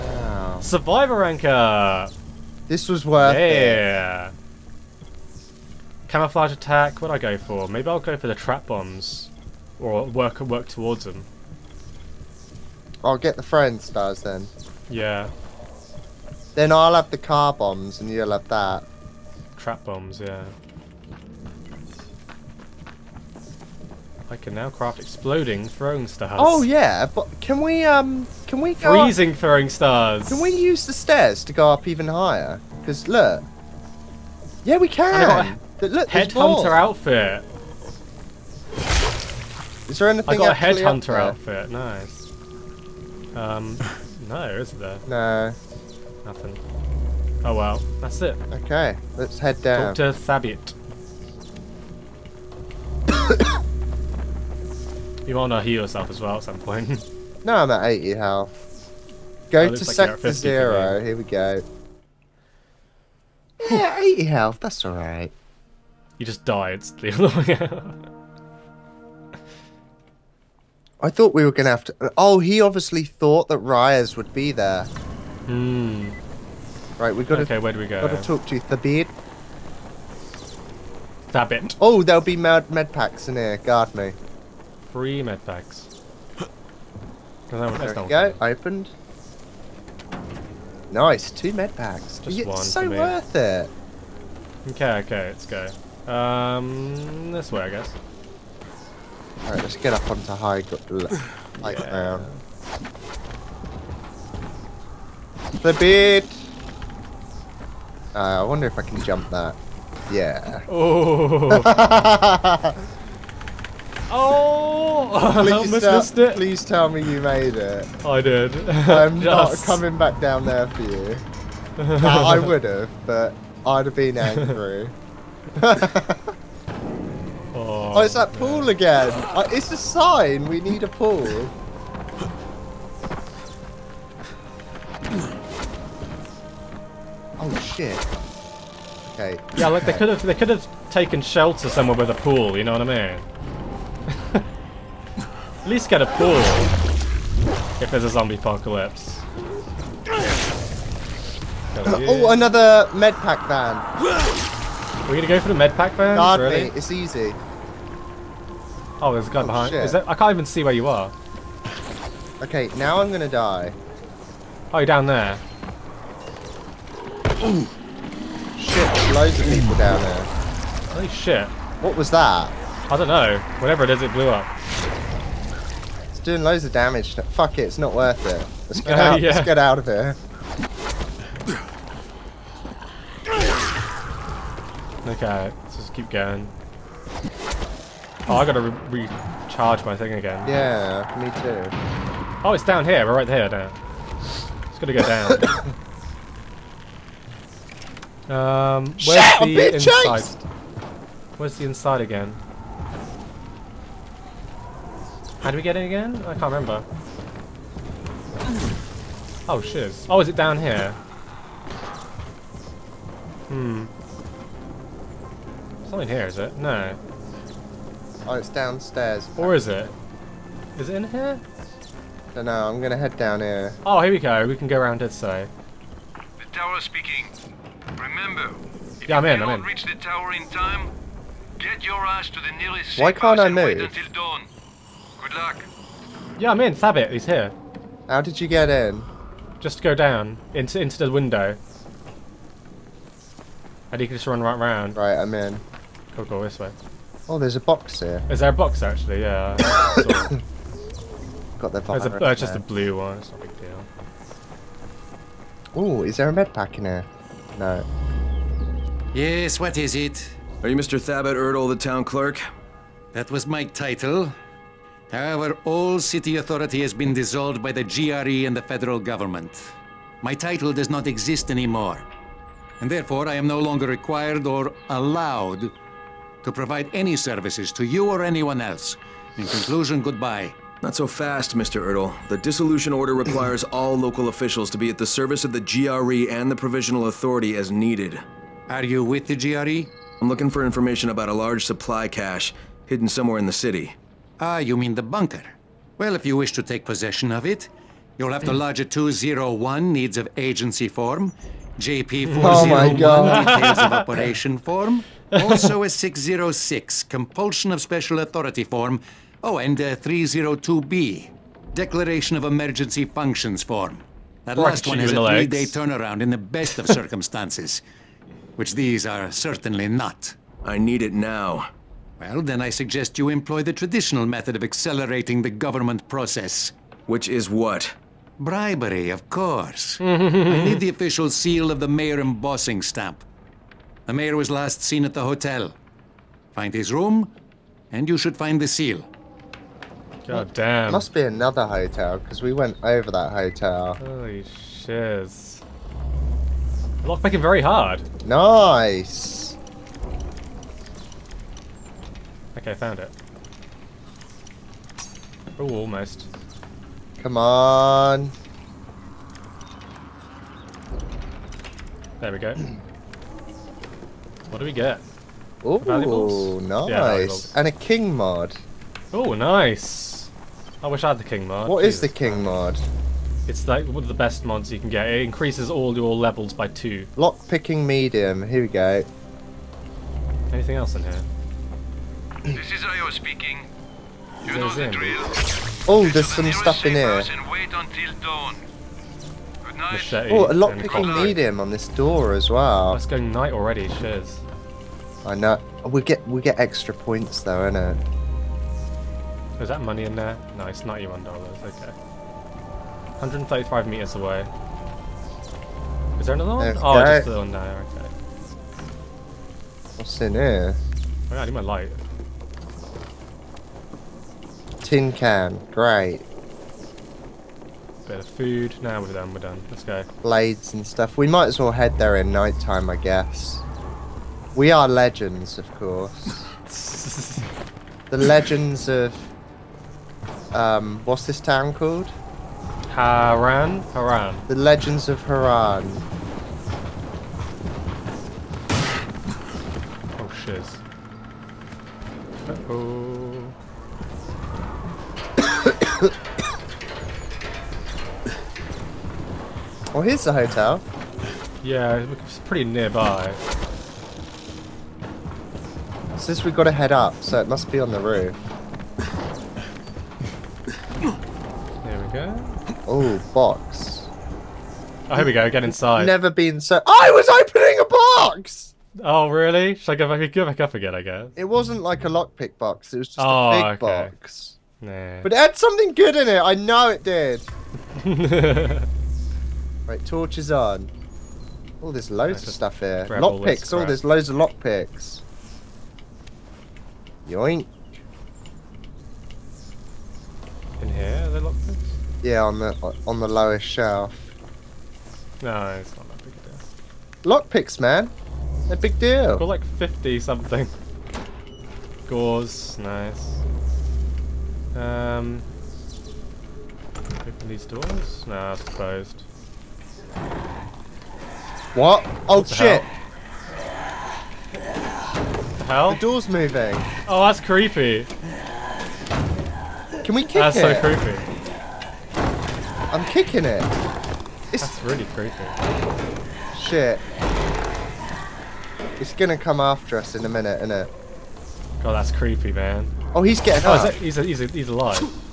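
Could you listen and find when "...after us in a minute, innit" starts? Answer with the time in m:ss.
8:49.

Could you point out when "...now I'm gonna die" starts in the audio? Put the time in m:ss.
2:42.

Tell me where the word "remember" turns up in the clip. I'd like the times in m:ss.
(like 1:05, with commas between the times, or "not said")
3:26, 3:47.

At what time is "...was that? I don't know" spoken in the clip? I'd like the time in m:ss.
2:51.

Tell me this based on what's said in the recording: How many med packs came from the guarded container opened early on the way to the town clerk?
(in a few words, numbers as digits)
2.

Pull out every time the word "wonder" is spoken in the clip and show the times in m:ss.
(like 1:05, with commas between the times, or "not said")
1:48.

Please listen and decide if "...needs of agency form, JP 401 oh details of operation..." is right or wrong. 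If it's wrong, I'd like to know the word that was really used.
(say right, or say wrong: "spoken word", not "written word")
right.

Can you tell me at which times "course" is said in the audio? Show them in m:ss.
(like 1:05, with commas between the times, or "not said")
5:29, 7:05.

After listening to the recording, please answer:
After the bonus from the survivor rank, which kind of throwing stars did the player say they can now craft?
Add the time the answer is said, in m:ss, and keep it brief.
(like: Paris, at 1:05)
Exploding throwing stars, at 0:24.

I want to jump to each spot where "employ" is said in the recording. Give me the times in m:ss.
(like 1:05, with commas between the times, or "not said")
5:23.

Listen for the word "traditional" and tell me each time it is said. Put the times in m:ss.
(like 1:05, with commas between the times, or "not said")
5:23.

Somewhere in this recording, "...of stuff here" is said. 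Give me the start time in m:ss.
8:02.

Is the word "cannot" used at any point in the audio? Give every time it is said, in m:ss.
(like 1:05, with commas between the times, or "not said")
3:49.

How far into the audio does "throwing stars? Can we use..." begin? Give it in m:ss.
0:29.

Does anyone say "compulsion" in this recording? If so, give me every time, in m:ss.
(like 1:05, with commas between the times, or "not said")
5:07.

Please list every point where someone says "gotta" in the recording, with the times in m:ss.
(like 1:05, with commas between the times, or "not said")
3:08.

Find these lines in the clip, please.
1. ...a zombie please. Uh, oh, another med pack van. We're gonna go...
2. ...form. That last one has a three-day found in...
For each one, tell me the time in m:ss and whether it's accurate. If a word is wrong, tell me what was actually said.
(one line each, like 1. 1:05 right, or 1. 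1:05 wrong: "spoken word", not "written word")
1. 2:28 wrong: "apocalypse", not "please"
2. 5:13 wrong: "turnaround", not "found".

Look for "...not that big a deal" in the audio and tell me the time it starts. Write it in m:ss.
8:15.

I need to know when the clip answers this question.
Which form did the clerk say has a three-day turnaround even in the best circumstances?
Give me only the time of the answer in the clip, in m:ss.
5:09.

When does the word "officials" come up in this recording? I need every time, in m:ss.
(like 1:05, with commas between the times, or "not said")
4:44, 5:30.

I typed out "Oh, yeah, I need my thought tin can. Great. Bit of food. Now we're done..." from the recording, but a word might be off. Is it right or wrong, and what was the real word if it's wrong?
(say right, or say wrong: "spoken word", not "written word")
wrong: "light", not "thought".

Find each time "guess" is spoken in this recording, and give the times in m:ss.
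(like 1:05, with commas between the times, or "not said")
1:37, 7:02, 7:51.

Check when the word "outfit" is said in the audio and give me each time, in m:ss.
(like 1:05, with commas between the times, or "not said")
0:36, 0:41.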